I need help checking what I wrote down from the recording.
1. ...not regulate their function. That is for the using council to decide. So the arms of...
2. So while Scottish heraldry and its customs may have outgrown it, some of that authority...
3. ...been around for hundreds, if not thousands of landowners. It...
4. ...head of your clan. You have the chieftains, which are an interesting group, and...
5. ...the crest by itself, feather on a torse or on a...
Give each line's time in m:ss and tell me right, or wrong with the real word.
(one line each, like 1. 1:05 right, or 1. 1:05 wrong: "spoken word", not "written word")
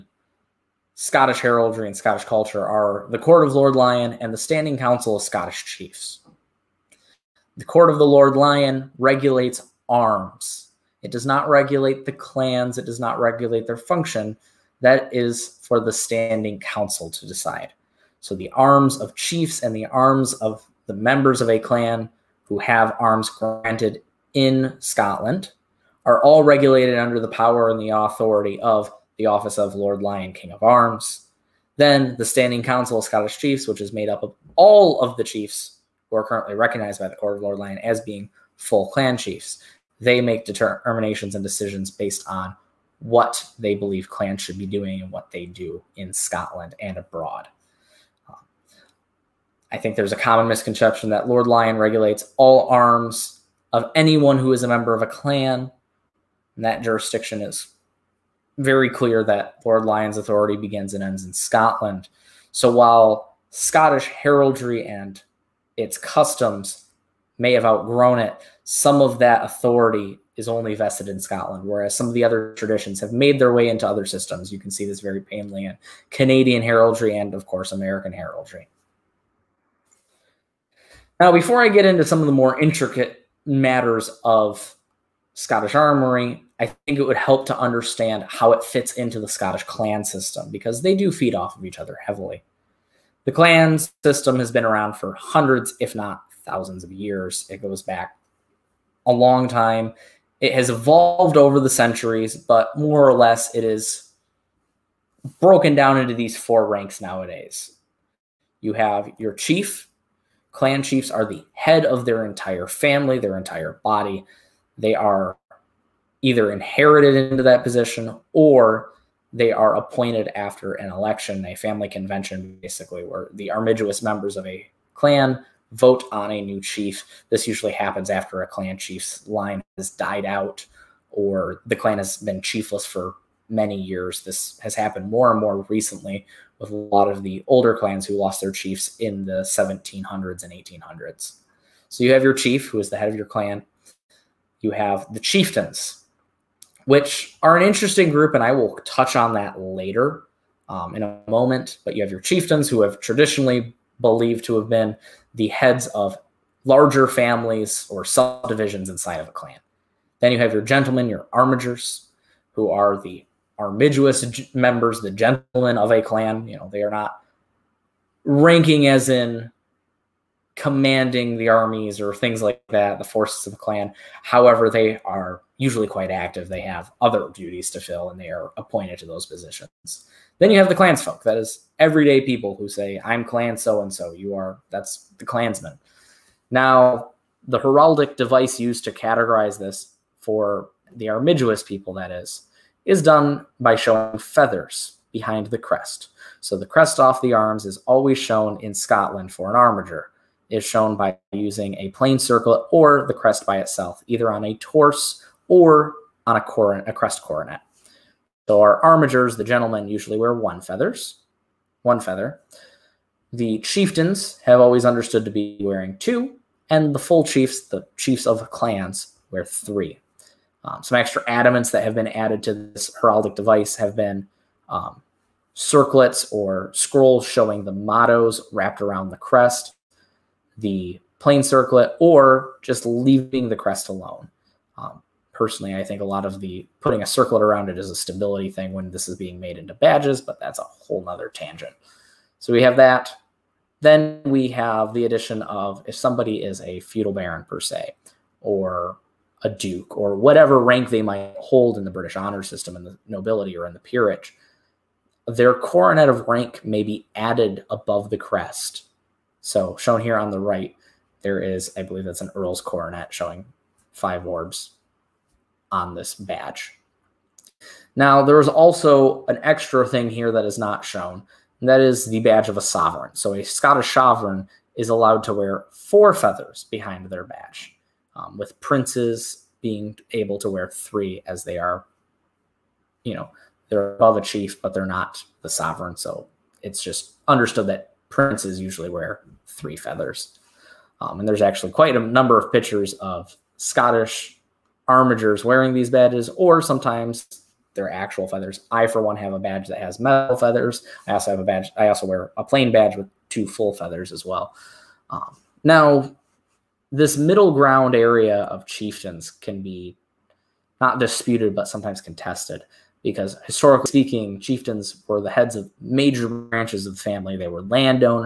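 1. 0:13 wrong: "standing", not "using"
2. 1:02 right
3. 1:34 wrong: "years", not "landowners"
4. 2:22 right
5. 3:23 wrong: "either", not "feather".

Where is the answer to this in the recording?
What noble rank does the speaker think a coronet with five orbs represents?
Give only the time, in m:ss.
4:22.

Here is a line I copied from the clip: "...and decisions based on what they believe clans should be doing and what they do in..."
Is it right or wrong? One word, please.
right.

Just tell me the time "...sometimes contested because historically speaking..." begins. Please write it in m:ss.
5:11.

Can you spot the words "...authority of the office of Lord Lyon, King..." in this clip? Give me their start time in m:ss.
0:27.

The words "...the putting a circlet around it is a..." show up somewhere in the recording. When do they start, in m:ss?
3:56.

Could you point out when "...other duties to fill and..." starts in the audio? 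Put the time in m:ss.
2:57.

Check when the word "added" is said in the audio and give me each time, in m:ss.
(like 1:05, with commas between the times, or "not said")
3:42, 4:17.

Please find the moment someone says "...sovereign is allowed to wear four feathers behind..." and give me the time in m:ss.
4:33.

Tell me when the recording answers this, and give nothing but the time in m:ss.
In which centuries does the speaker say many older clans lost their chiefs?
2:19.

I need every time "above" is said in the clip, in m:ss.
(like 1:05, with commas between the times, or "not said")
4:17, 4:43.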